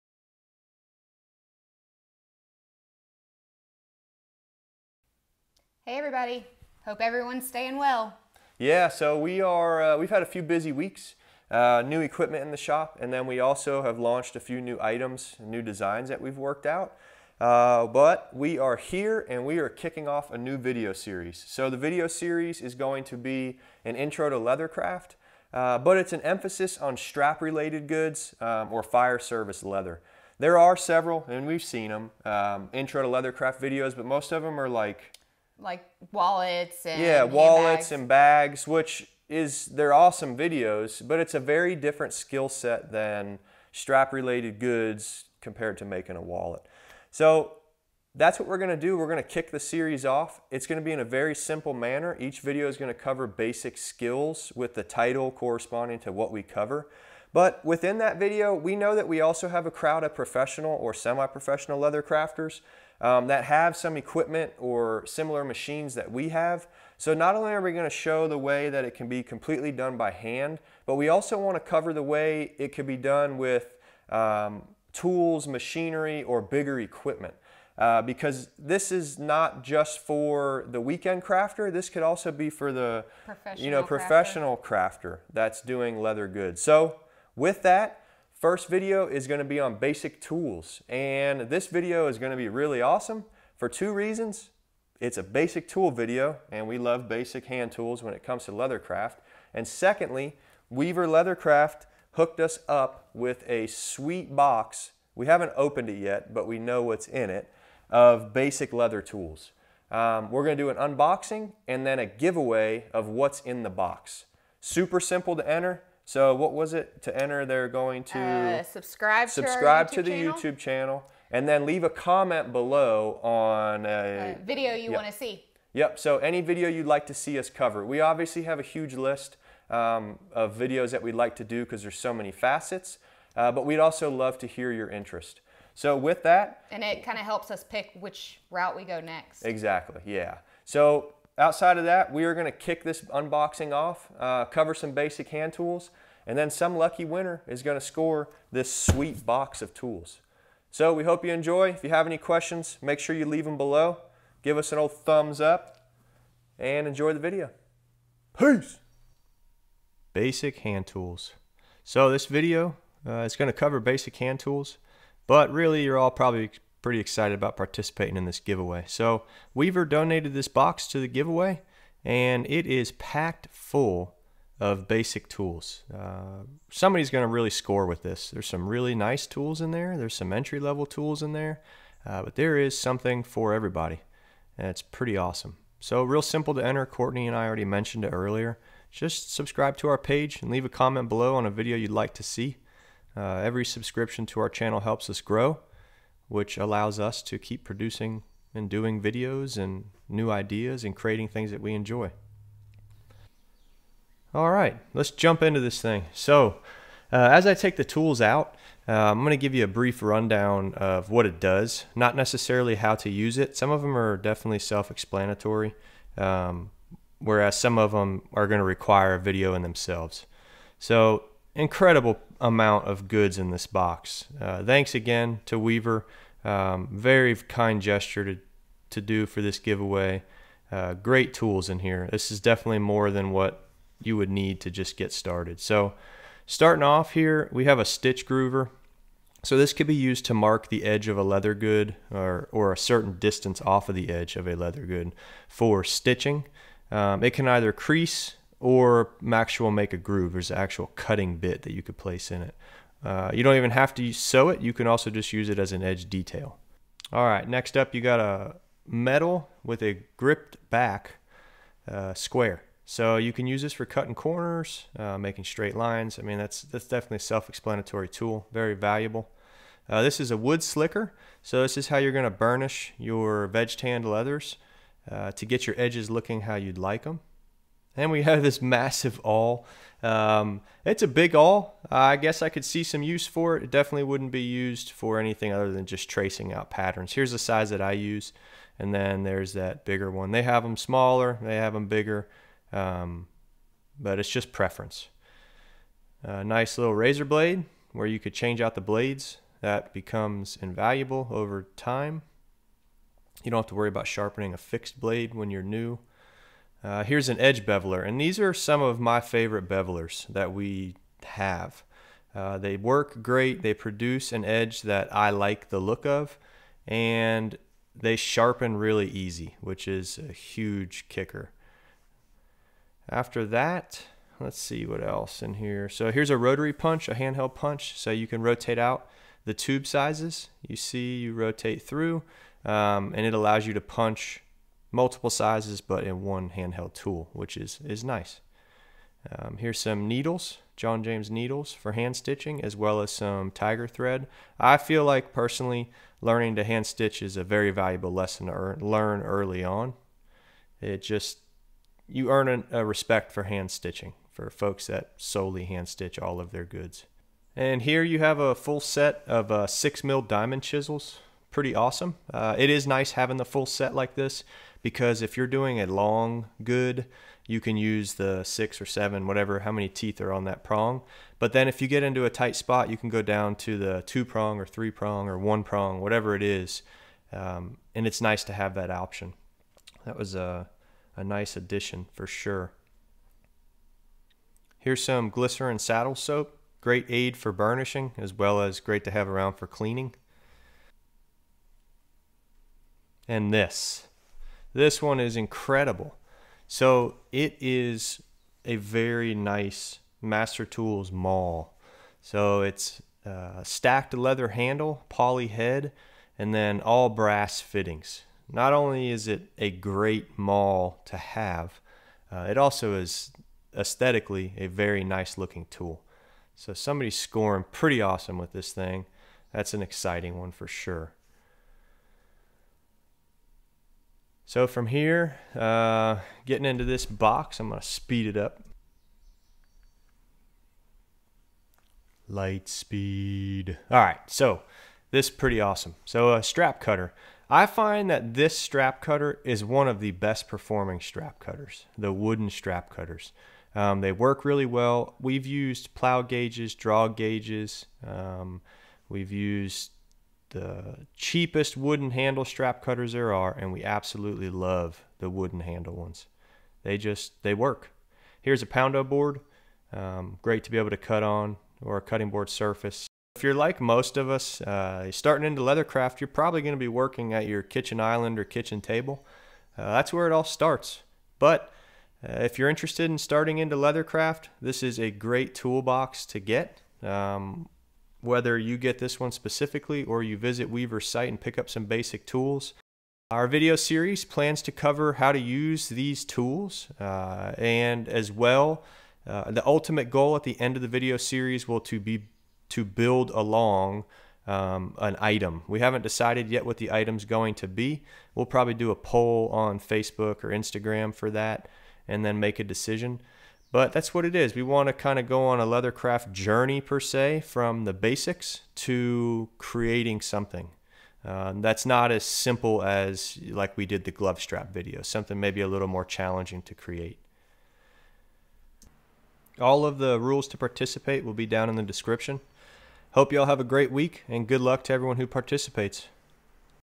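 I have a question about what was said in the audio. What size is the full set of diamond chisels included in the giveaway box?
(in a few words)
6 mm.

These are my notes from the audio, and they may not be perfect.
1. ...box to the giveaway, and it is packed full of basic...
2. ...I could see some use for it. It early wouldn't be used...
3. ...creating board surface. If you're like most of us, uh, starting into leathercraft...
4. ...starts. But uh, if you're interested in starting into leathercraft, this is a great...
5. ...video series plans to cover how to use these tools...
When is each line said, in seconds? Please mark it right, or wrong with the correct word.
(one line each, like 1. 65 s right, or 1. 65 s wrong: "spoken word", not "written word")
1. 170 s right
2. 282 s wrong: "definitely", not "early"
3. 462 s wrong: "cutting", not "creating"
4. 470 s right
5. 483 s right.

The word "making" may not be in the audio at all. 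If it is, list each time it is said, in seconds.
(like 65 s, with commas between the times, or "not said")
45 s, 265 s.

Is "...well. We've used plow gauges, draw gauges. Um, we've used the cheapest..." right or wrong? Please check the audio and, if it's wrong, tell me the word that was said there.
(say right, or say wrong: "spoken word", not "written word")
right.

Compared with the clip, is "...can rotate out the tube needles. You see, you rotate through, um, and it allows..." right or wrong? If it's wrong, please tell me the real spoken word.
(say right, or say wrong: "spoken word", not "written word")
wrong: "sizes", not "needles".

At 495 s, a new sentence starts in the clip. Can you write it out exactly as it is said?
We haven't decided yet what the item's going to be.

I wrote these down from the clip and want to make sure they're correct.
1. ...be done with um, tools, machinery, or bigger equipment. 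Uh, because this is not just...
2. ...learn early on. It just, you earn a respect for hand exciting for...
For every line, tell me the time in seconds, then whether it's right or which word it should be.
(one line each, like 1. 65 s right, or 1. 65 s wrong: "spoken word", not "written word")
1. 72 s right
2. 348 s wrong: "stitching", not "exciting".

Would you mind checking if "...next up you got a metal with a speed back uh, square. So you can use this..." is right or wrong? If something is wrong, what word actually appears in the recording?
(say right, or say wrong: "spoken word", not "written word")
wrong: "gripped", not "speed".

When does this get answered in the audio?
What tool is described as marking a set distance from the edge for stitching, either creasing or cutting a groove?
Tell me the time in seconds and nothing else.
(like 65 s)
237 s.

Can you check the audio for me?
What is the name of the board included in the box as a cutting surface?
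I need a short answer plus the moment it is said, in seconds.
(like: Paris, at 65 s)
Poundo board, at 458 s.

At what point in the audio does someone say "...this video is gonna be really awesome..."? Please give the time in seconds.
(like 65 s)
91 s.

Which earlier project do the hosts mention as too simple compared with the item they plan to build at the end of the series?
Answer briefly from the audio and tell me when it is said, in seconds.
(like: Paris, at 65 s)
Glove strap, at 514 s.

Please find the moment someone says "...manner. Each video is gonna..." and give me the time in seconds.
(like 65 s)
51 s.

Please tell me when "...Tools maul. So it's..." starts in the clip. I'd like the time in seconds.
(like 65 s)
400 s.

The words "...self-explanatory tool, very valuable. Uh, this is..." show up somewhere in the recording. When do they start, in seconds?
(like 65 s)
267 s.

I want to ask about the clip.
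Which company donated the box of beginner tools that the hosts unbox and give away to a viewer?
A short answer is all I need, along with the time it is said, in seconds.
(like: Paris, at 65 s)
Weaver Leathercraft, at 100 s.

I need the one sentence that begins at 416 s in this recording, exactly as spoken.
So somebody's scoring pretty awesome with this thing.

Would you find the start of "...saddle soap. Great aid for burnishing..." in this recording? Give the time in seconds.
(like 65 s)
385 s.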